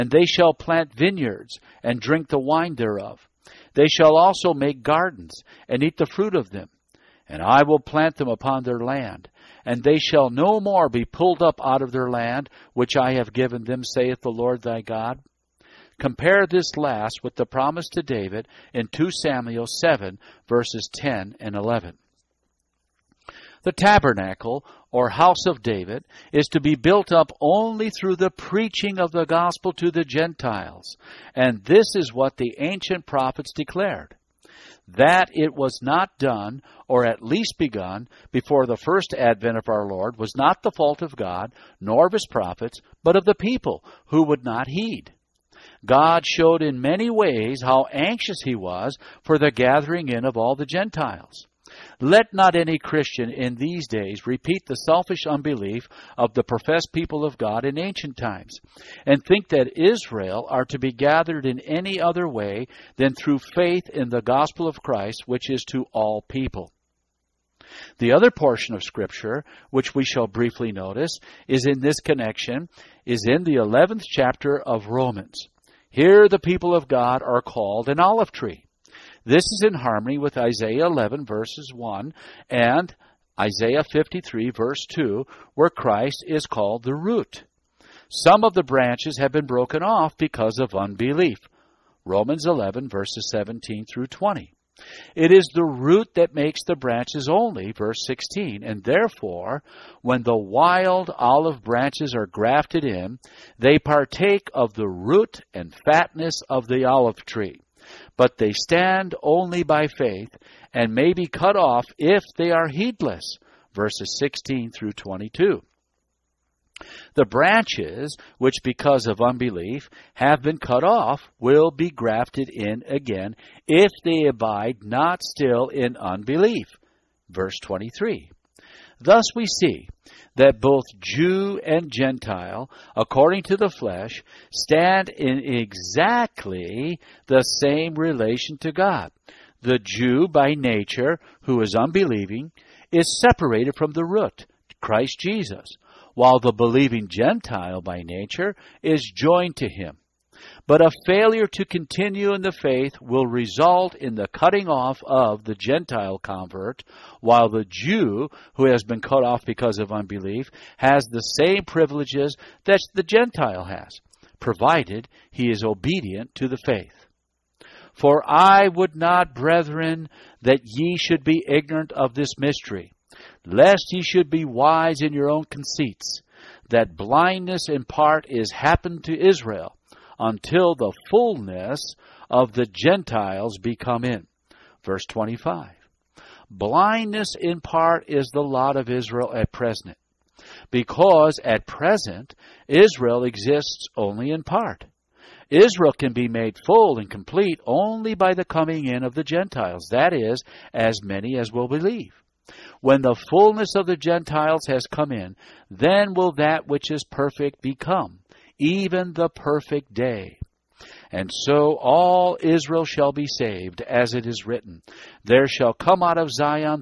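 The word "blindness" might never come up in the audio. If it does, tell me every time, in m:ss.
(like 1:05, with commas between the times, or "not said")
2:56, 3:06.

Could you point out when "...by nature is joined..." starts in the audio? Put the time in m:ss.
2:27.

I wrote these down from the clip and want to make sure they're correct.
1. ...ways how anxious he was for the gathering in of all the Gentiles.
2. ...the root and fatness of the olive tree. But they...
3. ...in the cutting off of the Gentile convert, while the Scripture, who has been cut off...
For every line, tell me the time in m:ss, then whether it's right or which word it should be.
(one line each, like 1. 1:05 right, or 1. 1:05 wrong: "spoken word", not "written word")
1. 0:47 right
2. 1:44 right
3. 2:33 wrong: "Jew", not "Scripture".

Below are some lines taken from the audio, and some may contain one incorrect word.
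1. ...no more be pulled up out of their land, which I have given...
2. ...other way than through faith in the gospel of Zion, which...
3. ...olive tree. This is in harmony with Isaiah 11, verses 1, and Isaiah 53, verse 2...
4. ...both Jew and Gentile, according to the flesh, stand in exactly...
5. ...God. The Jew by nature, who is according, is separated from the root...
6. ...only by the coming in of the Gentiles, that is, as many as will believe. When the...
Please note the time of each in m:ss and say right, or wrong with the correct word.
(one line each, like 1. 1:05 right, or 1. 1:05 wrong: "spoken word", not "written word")
1. 0:10 right
2. 1:01 wrong: "Christ", not "Zion"
3. 1:18 right
4. 2:10 right
5. 2:18 wrong: "unbelieving", not "according"
6. 3:17 right.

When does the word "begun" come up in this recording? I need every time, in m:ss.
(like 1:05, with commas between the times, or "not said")
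0:37.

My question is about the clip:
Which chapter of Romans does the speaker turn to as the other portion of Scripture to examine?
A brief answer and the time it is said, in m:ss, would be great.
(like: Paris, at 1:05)
11th chapter, at 1:13.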